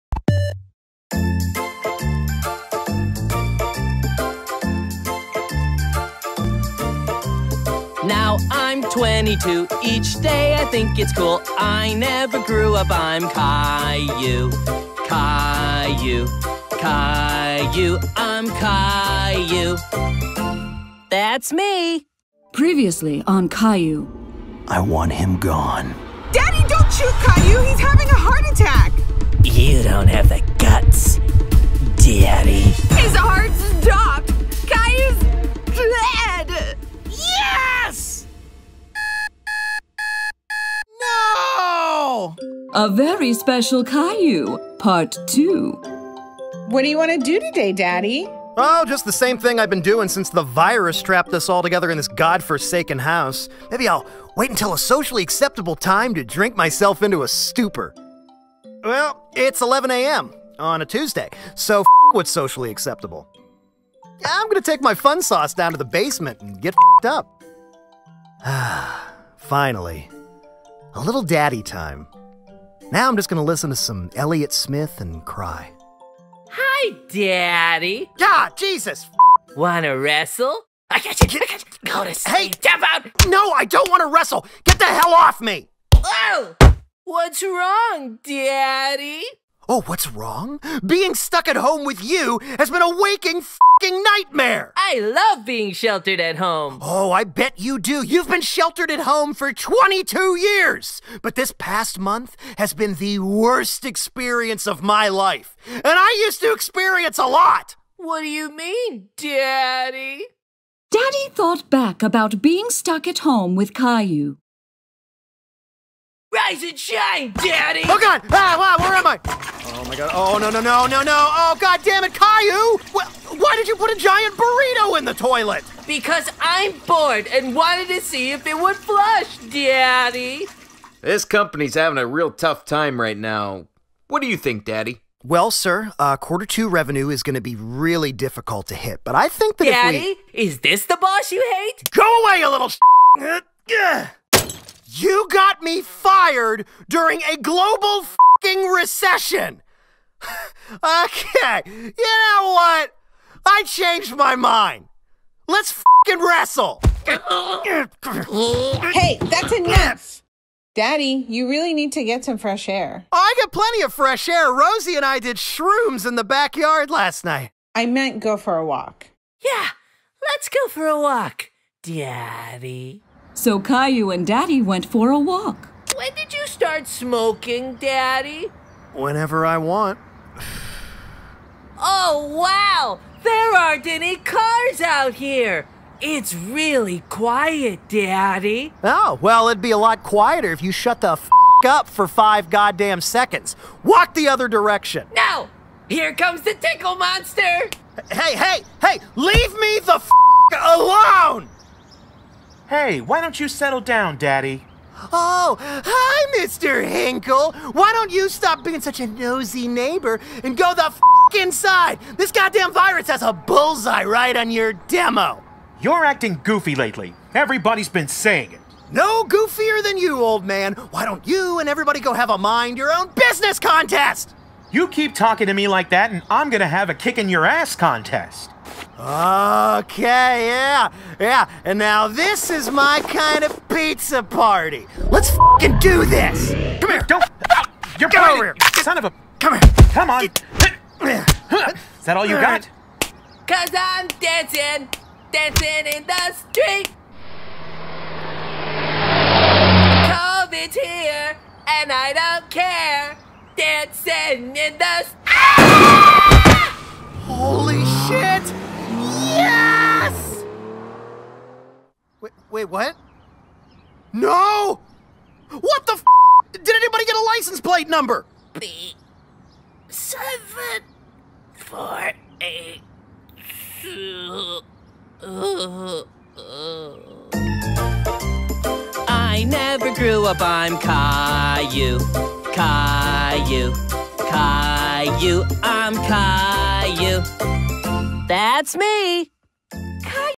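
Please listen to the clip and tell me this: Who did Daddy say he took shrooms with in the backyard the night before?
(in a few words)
Rosie.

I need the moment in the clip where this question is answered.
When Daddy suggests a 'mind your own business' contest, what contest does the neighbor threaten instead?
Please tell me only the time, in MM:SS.
03:46.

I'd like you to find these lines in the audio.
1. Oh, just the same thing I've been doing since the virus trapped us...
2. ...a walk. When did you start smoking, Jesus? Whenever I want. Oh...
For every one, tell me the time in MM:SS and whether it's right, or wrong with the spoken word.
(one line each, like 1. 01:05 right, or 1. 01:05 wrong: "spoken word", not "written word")
1. 00:48 right
2. 02:55 wrong: "Daddy", not "Jesus".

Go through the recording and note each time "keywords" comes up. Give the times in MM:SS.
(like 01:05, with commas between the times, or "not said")
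not said.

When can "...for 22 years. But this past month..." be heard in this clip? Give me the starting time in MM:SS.
01:39.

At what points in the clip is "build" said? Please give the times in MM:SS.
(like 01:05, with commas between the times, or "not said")
not said.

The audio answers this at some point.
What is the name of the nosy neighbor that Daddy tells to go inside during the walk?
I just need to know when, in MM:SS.
03:26.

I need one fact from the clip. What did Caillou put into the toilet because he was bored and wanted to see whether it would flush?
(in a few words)
giant burrito.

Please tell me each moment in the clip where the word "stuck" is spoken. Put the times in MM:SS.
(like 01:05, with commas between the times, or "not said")
01:31, 01:52.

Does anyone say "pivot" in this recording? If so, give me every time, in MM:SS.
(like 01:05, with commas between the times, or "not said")
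not said.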